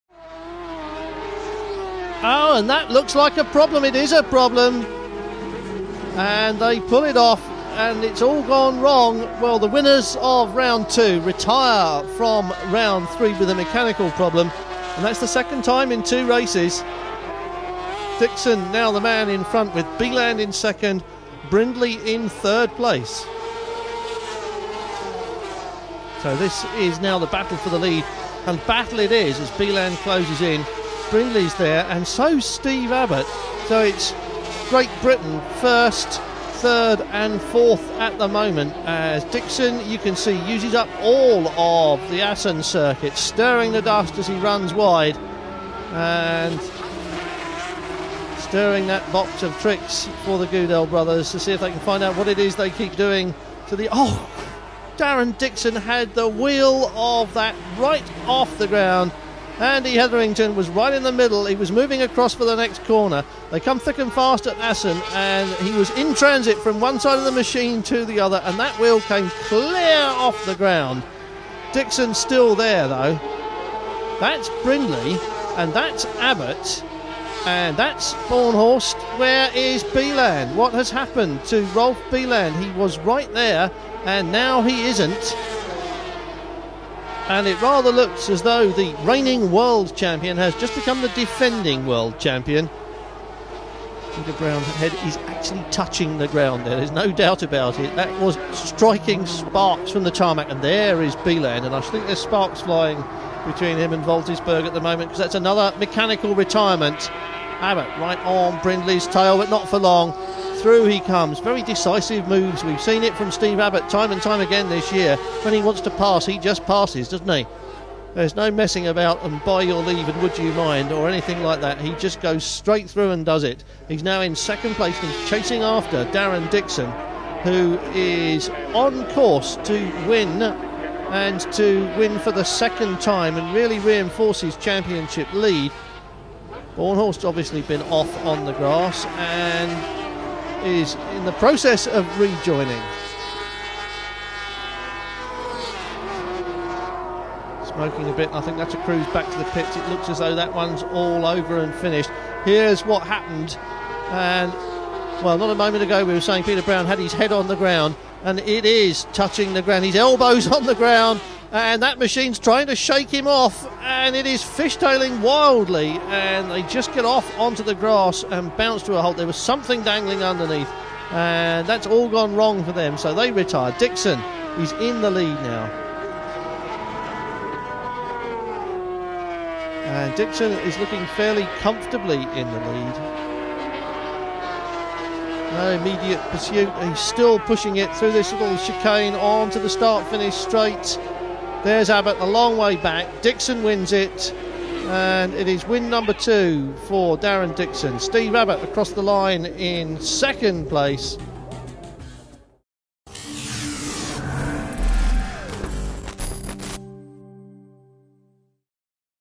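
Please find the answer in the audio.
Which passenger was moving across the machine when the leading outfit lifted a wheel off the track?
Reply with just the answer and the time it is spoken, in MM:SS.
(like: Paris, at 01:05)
Andy Hetherington, at 00:59.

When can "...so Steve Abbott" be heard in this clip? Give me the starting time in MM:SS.
00:32.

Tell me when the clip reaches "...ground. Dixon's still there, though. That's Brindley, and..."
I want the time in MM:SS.
01:10.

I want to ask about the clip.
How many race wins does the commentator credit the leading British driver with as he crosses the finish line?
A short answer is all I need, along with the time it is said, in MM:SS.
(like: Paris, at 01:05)
2, at 03:15.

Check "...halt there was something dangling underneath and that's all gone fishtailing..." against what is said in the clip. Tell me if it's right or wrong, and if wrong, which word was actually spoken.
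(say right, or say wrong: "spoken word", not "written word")
wrong: "wrong", not "fishtailing".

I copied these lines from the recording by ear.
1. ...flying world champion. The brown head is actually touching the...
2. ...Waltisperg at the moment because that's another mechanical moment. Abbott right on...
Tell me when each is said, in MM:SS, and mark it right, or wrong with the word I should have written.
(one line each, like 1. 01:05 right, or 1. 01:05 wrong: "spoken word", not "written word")
1. 01:31 wrong: "defending", not "flying"
2. 01:44 wrong: "retirement", not "moment".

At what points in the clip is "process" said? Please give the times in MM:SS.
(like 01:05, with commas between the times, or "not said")
02:21.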